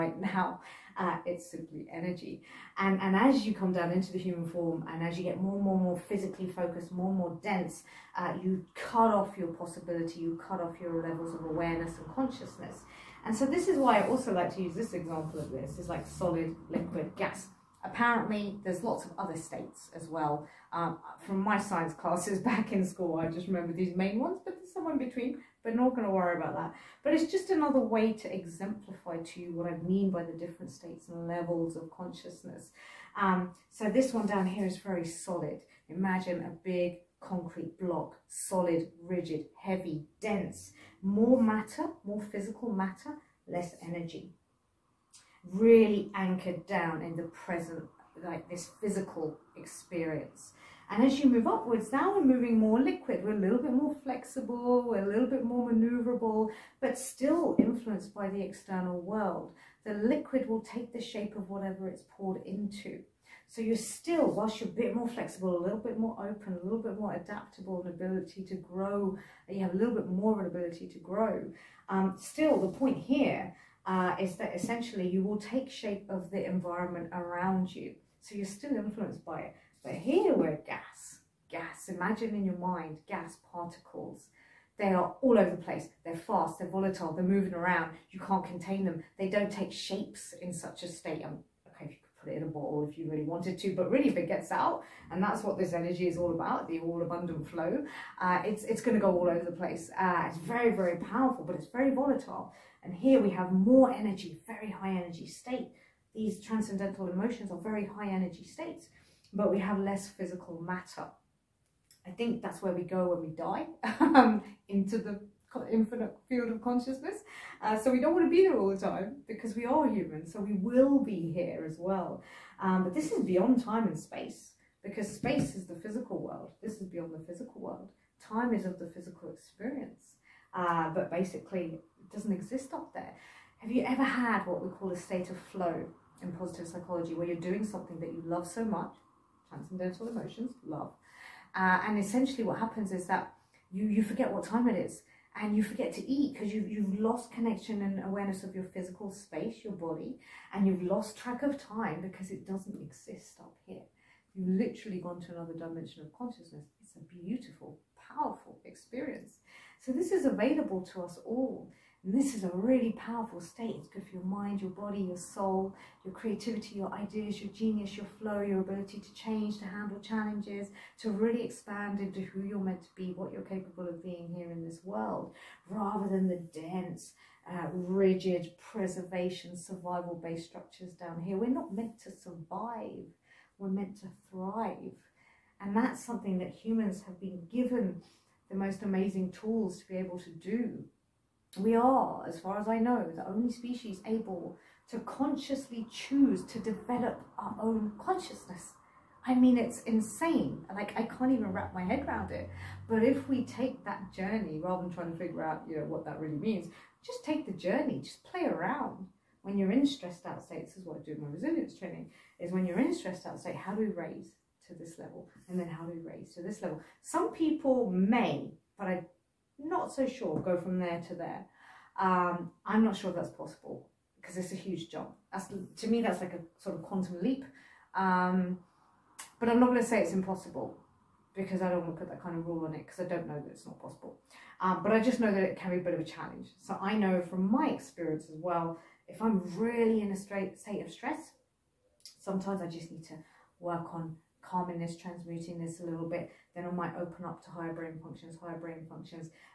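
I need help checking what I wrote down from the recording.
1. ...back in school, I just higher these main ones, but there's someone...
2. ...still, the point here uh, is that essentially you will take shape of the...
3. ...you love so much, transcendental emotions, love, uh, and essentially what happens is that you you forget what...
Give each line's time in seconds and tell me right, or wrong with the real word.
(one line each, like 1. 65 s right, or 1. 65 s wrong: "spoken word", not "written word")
1. 22 s wrong: "remember", not "higher"
2. 72 s right
3. 138 s right.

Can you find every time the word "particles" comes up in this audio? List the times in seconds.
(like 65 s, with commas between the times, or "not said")
83 s.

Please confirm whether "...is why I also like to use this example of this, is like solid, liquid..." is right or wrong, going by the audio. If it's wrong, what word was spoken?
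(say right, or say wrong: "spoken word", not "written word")
right.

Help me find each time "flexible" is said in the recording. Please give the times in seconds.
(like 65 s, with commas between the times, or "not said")
54 s, 65 s.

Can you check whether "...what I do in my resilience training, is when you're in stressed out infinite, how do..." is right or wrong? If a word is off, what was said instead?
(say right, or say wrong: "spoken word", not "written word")
wrong: "state", not "infinite".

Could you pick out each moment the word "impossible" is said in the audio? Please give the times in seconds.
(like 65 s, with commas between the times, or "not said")
230 s.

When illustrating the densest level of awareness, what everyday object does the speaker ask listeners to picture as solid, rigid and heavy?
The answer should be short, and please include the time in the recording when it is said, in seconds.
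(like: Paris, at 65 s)
A big concrete block, at 36 s.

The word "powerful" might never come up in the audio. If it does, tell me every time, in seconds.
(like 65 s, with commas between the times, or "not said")
100 s, 158 s, 162 s.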